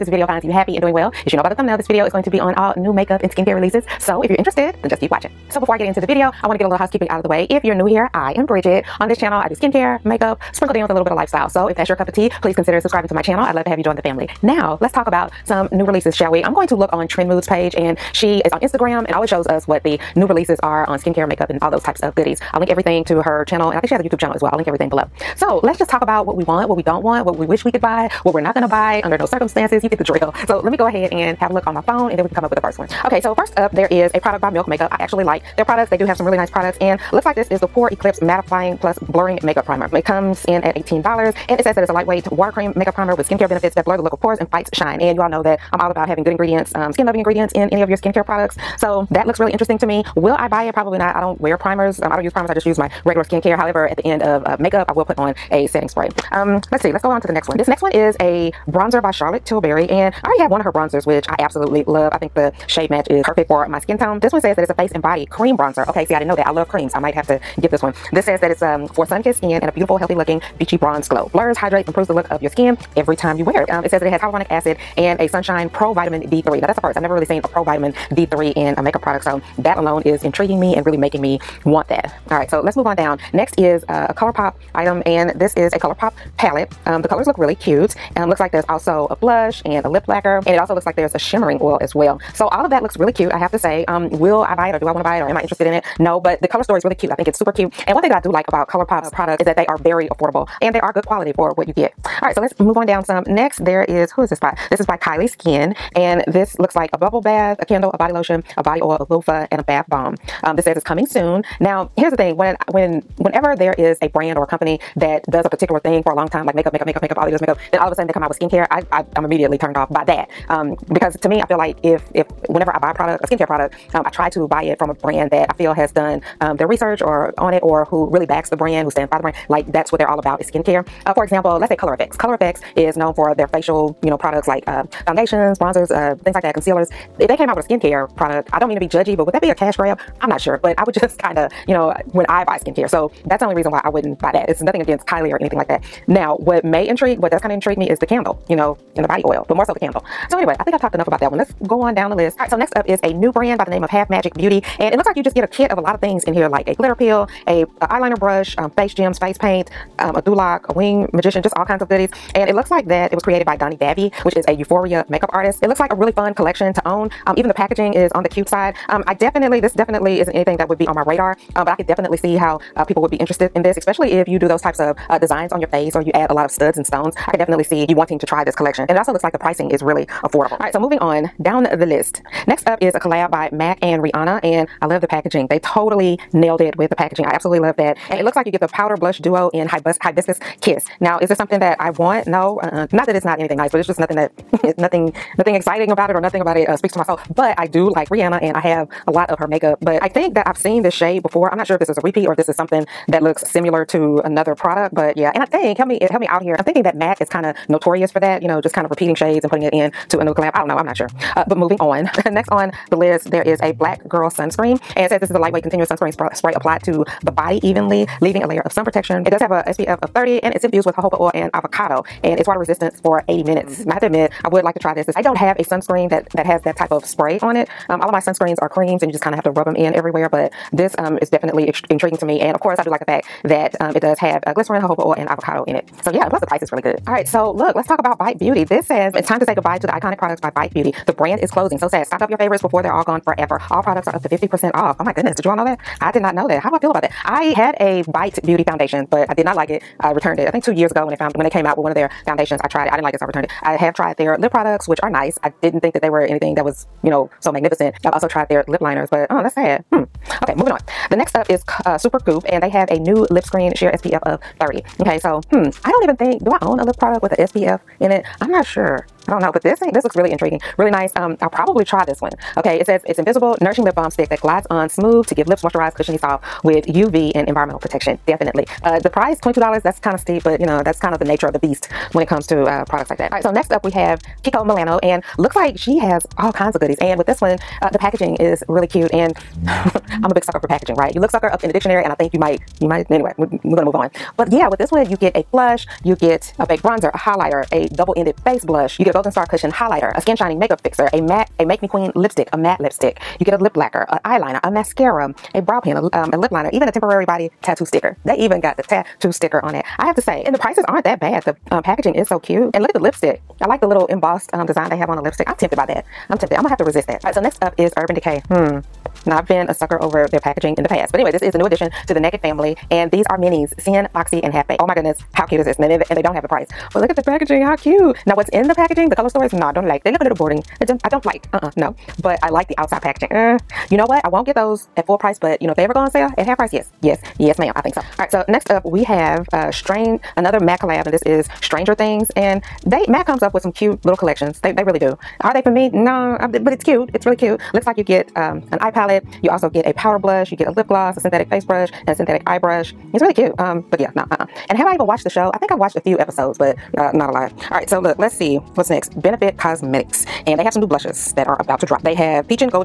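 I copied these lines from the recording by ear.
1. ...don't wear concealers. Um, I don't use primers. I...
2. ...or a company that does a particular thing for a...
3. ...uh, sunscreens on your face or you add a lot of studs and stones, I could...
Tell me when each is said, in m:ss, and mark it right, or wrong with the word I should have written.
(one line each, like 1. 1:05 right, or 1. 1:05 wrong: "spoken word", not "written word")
1. 0:51 wrong: "primers", not "concealers"
2. 1:54 right
3. 2:55 wrong: "designs", not "sunscreens".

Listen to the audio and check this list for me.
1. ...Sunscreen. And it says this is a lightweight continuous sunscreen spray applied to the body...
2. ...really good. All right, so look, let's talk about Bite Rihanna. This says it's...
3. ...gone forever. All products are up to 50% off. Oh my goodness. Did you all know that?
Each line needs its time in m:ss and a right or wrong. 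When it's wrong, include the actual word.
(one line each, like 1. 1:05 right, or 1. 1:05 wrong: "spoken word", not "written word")
1. 3:34 right
2. 3:56 wrong: "Beauty", not "Rihanna"
3. 4:03 right.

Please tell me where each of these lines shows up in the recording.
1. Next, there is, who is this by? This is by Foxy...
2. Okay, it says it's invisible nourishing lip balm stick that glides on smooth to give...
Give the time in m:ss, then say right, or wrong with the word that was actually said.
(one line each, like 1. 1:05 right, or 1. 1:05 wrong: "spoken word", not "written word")
1. 1:43 wrong: "Kylie", not "Foxy"
2. 4:32 right.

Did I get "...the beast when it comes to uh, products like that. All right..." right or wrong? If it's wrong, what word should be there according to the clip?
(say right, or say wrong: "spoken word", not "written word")
right.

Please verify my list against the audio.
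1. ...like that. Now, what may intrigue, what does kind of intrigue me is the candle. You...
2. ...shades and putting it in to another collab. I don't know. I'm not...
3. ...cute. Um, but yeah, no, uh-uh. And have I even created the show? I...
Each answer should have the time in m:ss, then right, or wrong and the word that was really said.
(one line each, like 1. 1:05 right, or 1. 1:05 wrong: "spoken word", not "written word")
1. 2:25 right
2. 3:29 right
3. 5:53 wrong: "watched", not "created".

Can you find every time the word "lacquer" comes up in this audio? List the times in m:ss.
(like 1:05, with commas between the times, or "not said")
1:30, 5:03.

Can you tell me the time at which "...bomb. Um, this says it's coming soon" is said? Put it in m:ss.
1:49.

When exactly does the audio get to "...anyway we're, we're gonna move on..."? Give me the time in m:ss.
4:53.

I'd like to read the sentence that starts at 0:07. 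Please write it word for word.
If you're new here, I am Bridget.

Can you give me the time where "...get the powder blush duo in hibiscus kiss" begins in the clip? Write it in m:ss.
3:08.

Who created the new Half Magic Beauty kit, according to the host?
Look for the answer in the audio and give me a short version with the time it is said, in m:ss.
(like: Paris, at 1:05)
Doniella Davy, at 2:43.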